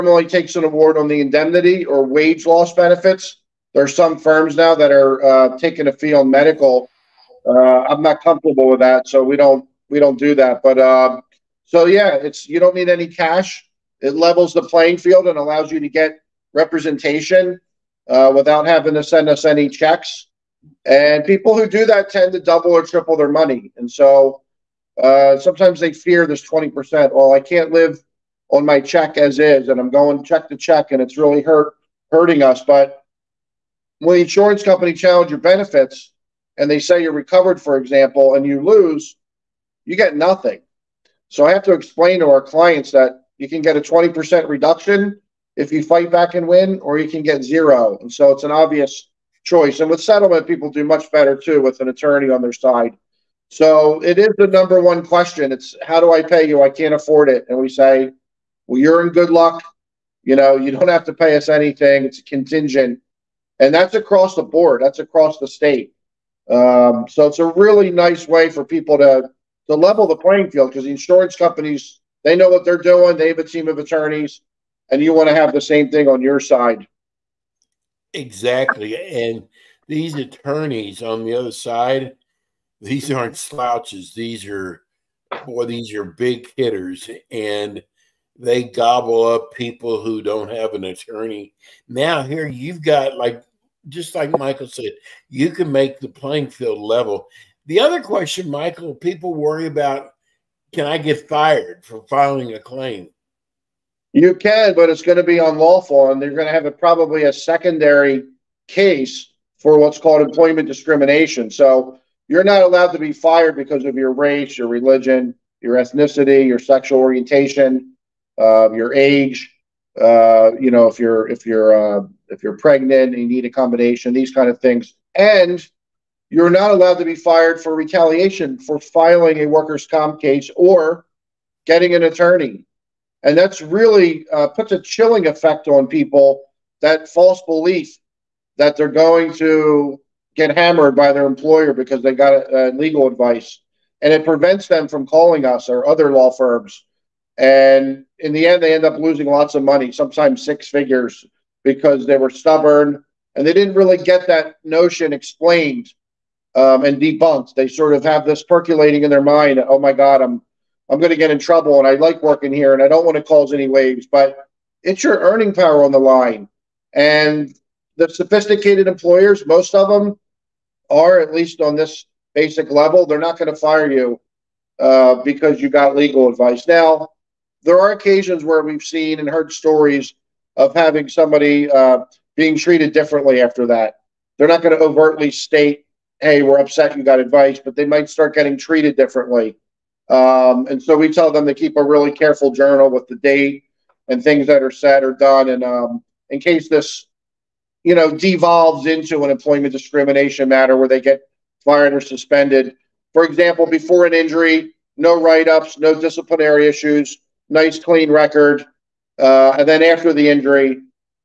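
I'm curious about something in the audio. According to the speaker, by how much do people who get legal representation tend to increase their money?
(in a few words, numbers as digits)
double or triple.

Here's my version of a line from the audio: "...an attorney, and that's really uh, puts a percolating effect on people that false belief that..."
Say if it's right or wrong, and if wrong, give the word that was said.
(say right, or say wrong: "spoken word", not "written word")
wrong: "chilling", not "percolating".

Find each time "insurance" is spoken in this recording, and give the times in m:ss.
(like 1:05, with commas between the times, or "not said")
0:34, 1:10.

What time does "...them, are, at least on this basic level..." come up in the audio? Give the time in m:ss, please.
2:49.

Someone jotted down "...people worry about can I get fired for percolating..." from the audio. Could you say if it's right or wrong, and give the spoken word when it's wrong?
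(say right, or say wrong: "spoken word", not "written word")
wrong: "filing", not "percolating".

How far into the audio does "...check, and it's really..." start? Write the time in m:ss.
0:30.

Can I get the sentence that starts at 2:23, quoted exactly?
And it prevents them from calling us or other law firms.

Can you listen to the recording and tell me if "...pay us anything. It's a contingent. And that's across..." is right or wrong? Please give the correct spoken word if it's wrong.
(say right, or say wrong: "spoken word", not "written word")
right.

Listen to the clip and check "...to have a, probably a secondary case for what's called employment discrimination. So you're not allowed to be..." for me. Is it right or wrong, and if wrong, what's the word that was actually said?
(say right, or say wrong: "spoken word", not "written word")
right.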